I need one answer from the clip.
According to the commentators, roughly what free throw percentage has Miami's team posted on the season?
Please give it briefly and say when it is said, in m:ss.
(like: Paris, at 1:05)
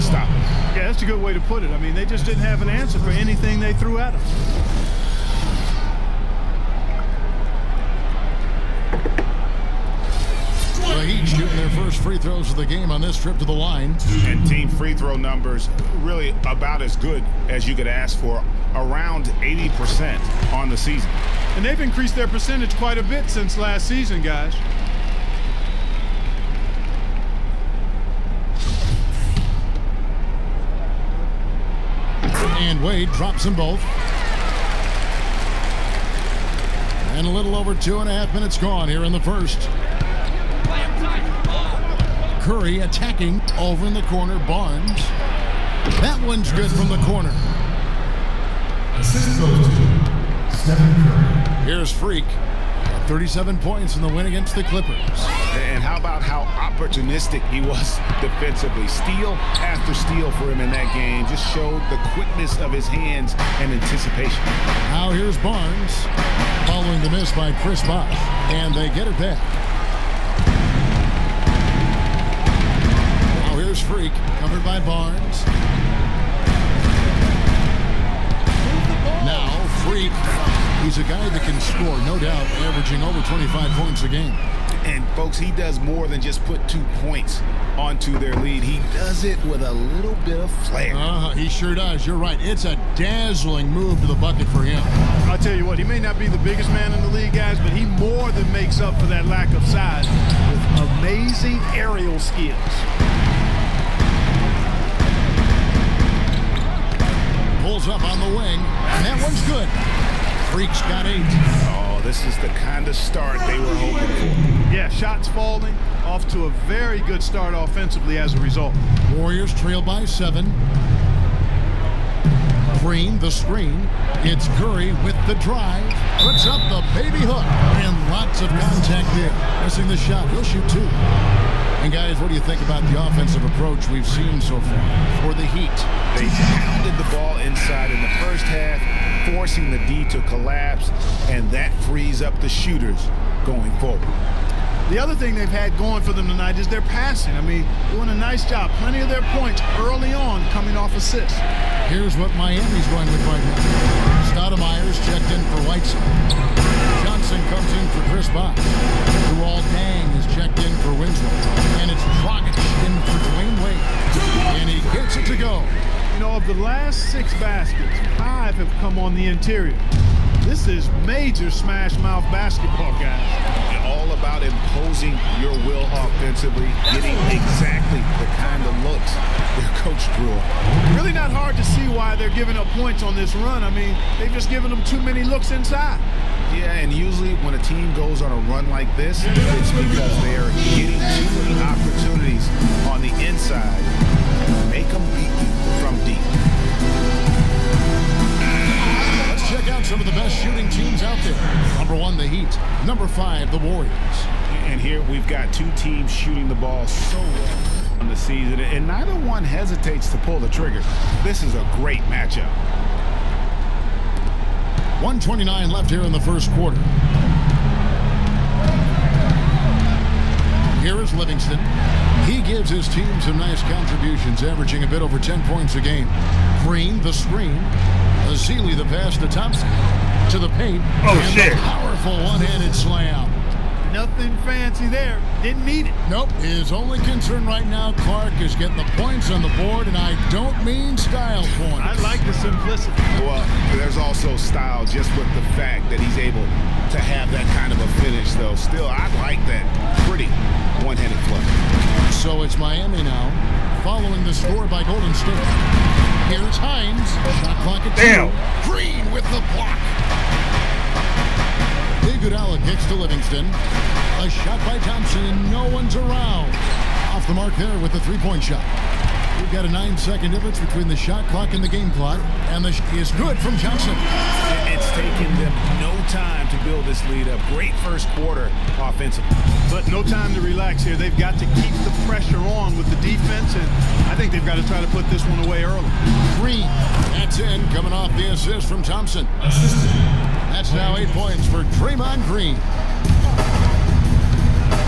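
80%, at 0:18.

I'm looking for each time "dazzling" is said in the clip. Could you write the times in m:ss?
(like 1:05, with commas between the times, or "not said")
1:32.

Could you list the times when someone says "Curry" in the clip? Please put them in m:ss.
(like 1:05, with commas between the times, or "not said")
0:42, 2:04.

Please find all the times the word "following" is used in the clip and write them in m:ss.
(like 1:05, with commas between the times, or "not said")
1:06, 4:13.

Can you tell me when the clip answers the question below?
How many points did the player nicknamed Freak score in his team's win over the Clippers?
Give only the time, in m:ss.
0:53.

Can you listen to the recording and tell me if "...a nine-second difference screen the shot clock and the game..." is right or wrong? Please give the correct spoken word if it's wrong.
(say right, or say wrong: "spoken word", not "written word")
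wrong: "between", not "screen".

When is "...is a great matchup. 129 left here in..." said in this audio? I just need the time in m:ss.
3:31.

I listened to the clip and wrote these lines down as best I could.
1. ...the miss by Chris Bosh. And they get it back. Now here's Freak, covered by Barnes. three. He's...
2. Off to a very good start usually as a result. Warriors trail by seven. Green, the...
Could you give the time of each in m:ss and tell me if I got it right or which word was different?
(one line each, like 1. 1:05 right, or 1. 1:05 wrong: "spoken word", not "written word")
1. 1:07 right
2. 1:56 wrong: "offensively", not "usually".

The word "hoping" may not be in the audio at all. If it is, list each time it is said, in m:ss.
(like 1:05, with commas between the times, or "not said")
1:53.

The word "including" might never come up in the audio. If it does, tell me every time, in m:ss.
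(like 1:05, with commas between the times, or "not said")
not said.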